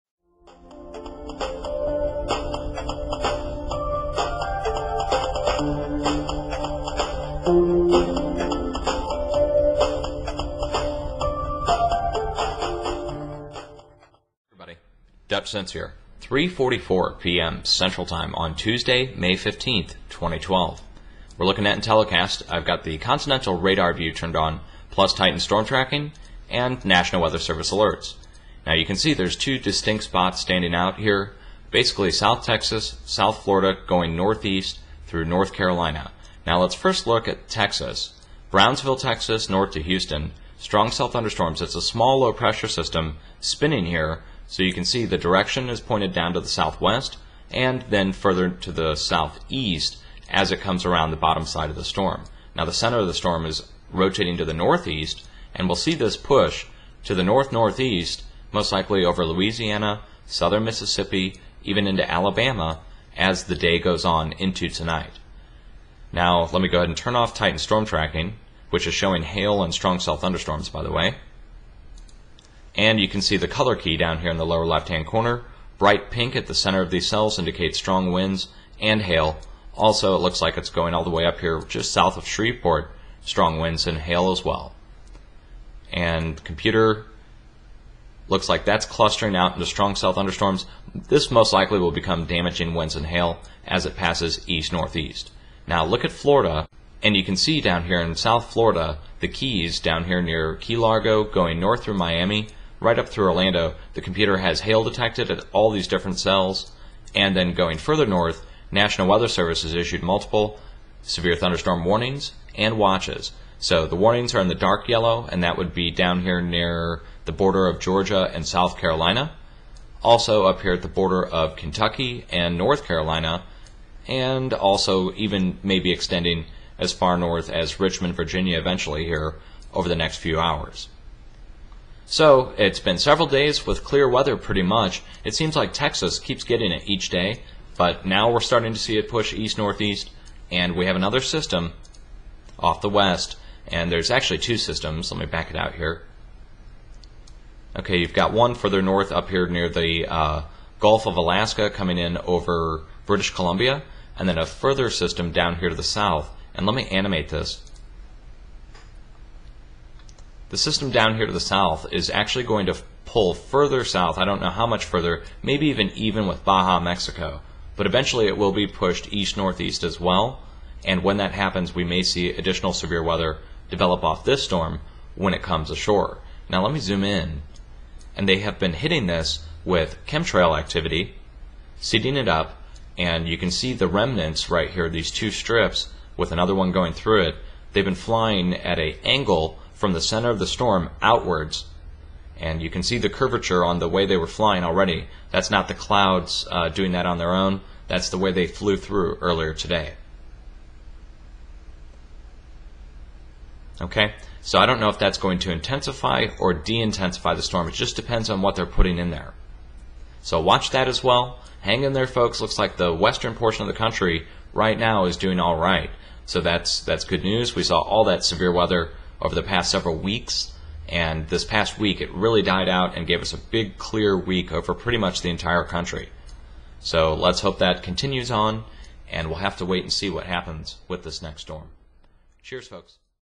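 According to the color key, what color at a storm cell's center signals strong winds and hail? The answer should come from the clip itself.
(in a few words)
Bright pink.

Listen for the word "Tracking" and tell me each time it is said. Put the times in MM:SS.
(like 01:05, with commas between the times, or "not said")
00:25, 01:07.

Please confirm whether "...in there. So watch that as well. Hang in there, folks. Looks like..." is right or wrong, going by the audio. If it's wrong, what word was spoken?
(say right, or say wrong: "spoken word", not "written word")
right.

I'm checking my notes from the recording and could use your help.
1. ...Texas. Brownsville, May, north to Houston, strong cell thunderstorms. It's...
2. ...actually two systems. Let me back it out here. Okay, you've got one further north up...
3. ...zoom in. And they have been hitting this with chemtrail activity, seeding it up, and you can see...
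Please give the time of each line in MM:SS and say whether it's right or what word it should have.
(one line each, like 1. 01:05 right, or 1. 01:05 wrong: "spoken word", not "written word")
1. 00:37 wrong: "Texas", not "May"
2. 02:24 right
3. 02:56 right.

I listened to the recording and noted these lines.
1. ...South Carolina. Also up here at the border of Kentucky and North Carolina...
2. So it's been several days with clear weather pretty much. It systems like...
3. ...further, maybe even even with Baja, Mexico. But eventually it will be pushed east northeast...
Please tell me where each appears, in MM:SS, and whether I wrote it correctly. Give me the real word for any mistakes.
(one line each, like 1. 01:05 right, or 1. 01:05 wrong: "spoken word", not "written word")
1. 01:58 right
2. 02:12 wrong: "seems", not "systems"
3. 02:44 right.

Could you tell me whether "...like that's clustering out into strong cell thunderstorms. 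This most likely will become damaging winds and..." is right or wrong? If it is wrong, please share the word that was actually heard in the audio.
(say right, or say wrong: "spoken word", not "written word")
right.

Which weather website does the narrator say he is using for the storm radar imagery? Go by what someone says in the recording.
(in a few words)
Intellicast.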